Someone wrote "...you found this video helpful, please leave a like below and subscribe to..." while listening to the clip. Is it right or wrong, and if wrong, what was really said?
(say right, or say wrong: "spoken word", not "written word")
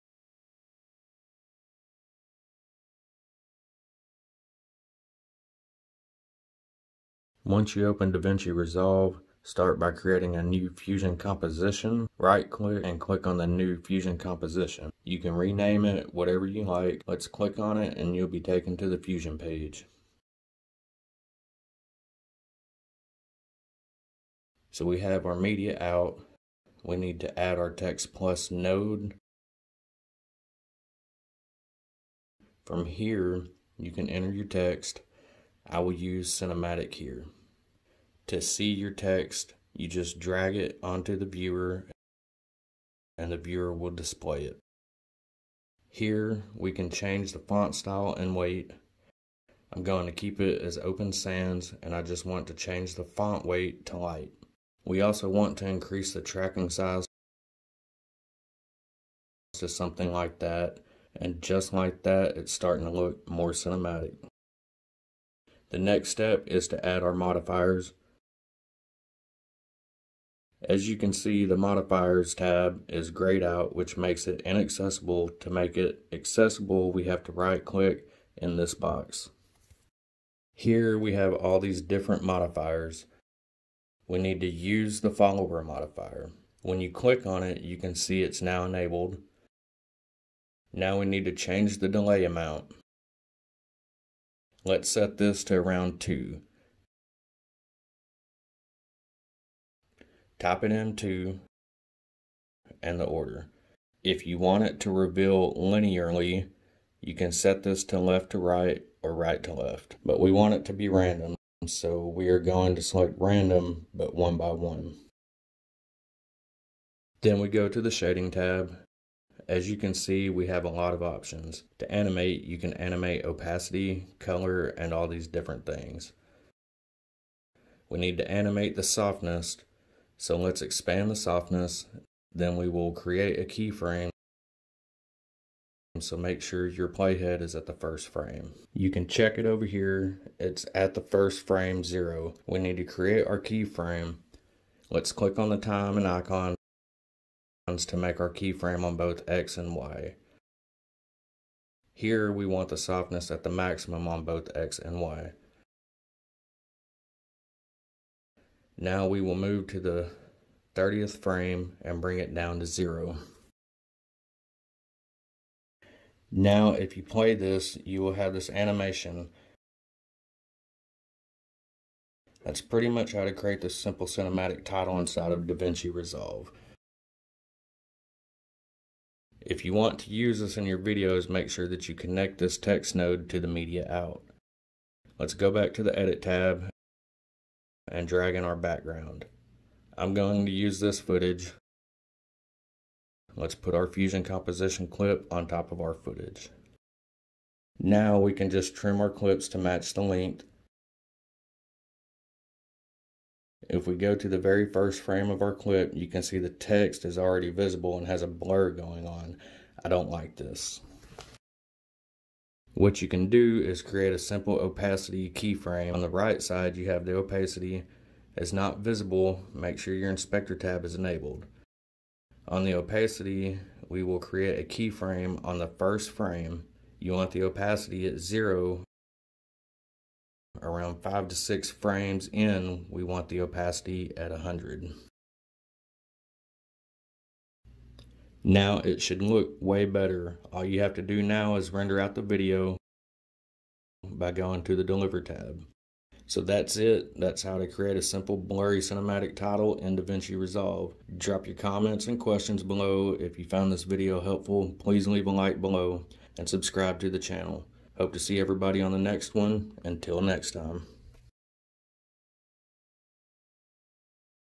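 right.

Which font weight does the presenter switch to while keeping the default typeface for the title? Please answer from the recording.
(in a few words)
light.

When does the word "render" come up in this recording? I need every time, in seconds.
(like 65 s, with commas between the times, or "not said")
241 s.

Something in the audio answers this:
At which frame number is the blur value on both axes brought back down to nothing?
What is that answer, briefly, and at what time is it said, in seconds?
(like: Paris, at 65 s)
30, at 160 s.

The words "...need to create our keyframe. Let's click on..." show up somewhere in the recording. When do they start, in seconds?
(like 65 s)
142 s.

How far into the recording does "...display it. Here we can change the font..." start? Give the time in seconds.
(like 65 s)
43 s.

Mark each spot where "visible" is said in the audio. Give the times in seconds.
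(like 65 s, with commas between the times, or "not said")
207 s, 218 s.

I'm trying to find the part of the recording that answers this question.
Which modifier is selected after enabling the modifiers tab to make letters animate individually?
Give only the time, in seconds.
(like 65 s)
85 s.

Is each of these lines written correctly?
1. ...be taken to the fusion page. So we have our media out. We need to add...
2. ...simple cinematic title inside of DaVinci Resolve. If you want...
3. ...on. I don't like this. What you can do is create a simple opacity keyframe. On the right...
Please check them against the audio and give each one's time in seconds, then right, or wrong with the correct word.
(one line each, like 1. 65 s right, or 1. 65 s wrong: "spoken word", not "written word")
1. 18 s right
2. 173 s right
3. 209 s right.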